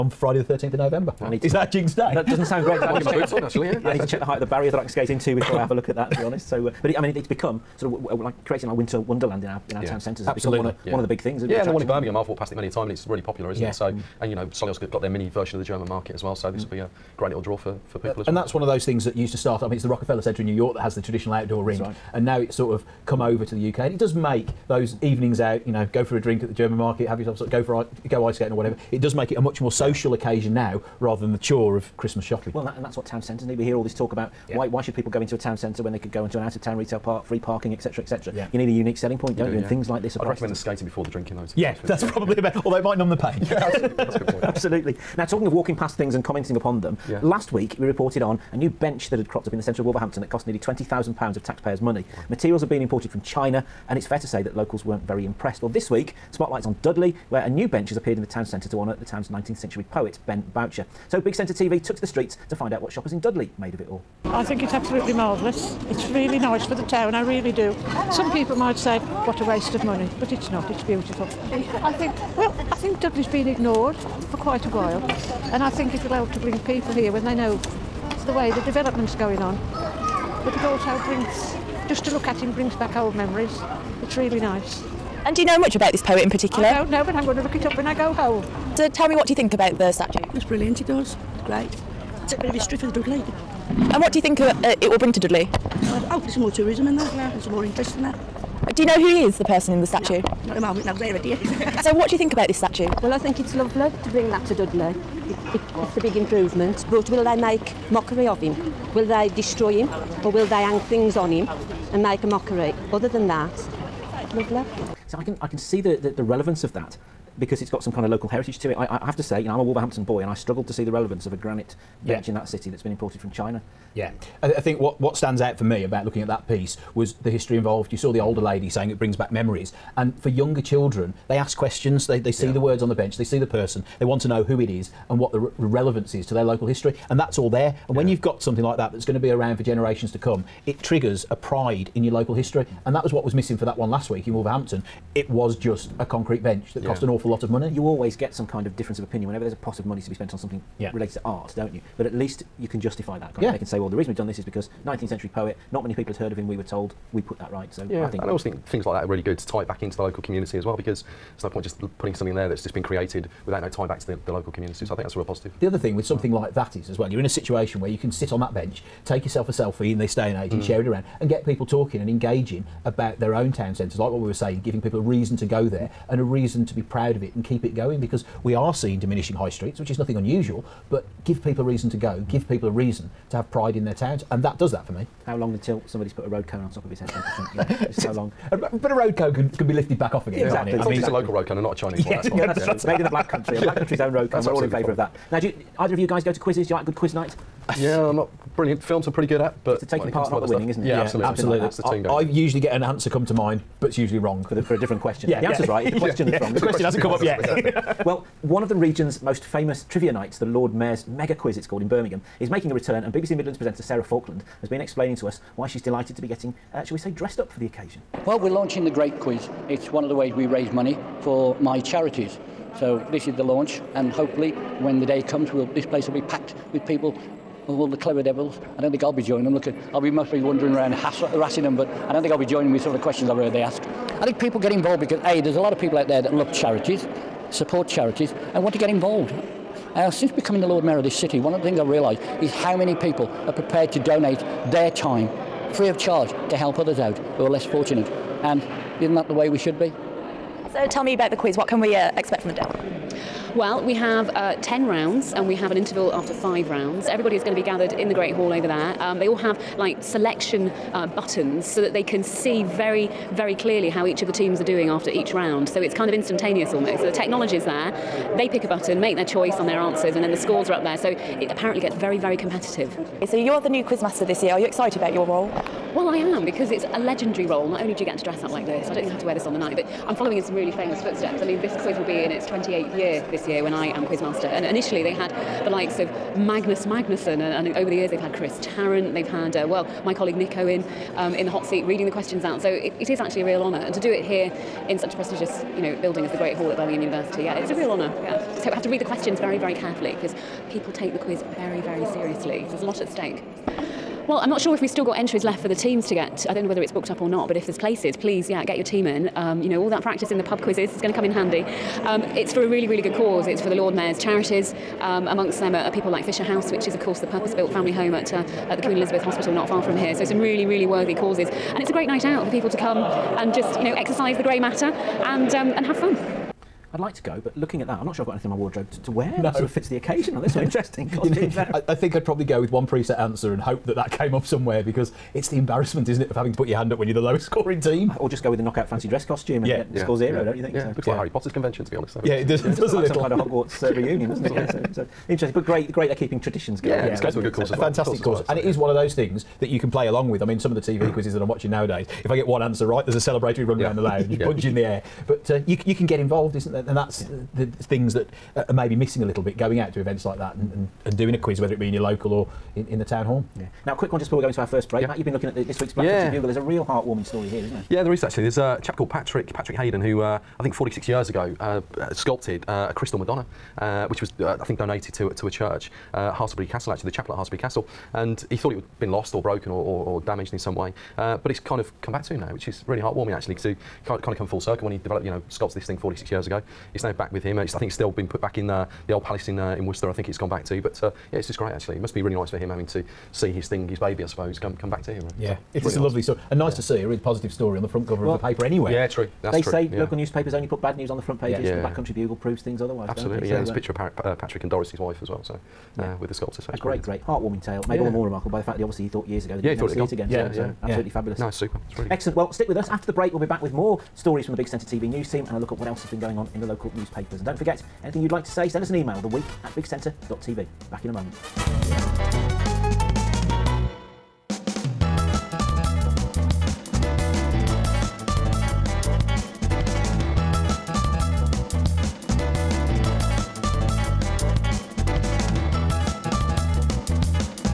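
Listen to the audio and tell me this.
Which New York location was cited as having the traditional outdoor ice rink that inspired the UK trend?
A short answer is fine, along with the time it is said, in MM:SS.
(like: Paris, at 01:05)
Rockefeller Centre, at 00:19.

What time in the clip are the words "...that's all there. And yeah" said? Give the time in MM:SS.
02:17.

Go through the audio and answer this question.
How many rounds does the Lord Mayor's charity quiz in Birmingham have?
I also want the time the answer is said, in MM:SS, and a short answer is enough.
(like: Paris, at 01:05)
10, at 04:14.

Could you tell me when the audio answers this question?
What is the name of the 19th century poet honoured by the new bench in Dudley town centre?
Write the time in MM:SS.
01:00.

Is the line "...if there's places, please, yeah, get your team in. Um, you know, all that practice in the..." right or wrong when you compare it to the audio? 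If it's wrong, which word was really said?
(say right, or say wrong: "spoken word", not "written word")
right.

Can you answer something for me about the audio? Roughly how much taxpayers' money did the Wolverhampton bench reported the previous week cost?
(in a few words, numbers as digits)
£20,000.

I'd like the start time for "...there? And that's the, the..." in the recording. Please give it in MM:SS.
05:56.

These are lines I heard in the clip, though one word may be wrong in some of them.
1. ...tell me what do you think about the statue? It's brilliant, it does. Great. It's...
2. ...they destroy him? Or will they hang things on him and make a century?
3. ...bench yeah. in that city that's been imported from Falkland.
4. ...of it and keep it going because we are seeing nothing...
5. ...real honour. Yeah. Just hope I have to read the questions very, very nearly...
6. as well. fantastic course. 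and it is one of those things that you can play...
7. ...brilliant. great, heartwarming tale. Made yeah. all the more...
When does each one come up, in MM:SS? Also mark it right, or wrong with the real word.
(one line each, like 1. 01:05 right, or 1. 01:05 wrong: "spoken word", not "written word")
1. 01:28 right
2. 01:49 wrong: "mockery", not "century"
3. 02:02 wrong: "China", not "Falkland"
4. 02:57 wrong: "diminishing", not "nothing"
5. 04:57 wrong: "carefully", not "nearly"
6. 05:47 right
7. 06:46 right.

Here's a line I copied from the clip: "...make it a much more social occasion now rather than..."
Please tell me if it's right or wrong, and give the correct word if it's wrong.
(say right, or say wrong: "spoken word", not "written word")
right.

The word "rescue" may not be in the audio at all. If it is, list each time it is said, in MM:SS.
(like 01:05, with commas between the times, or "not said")
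not said.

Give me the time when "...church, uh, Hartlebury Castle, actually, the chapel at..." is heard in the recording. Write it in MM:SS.
06:15.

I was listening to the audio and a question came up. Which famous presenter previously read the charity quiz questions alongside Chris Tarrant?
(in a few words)
Nick Owen.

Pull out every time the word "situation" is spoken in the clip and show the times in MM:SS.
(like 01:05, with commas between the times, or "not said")
02:47.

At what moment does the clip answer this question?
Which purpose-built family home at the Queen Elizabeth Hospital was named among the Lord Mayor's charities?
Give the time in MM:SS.
05:16.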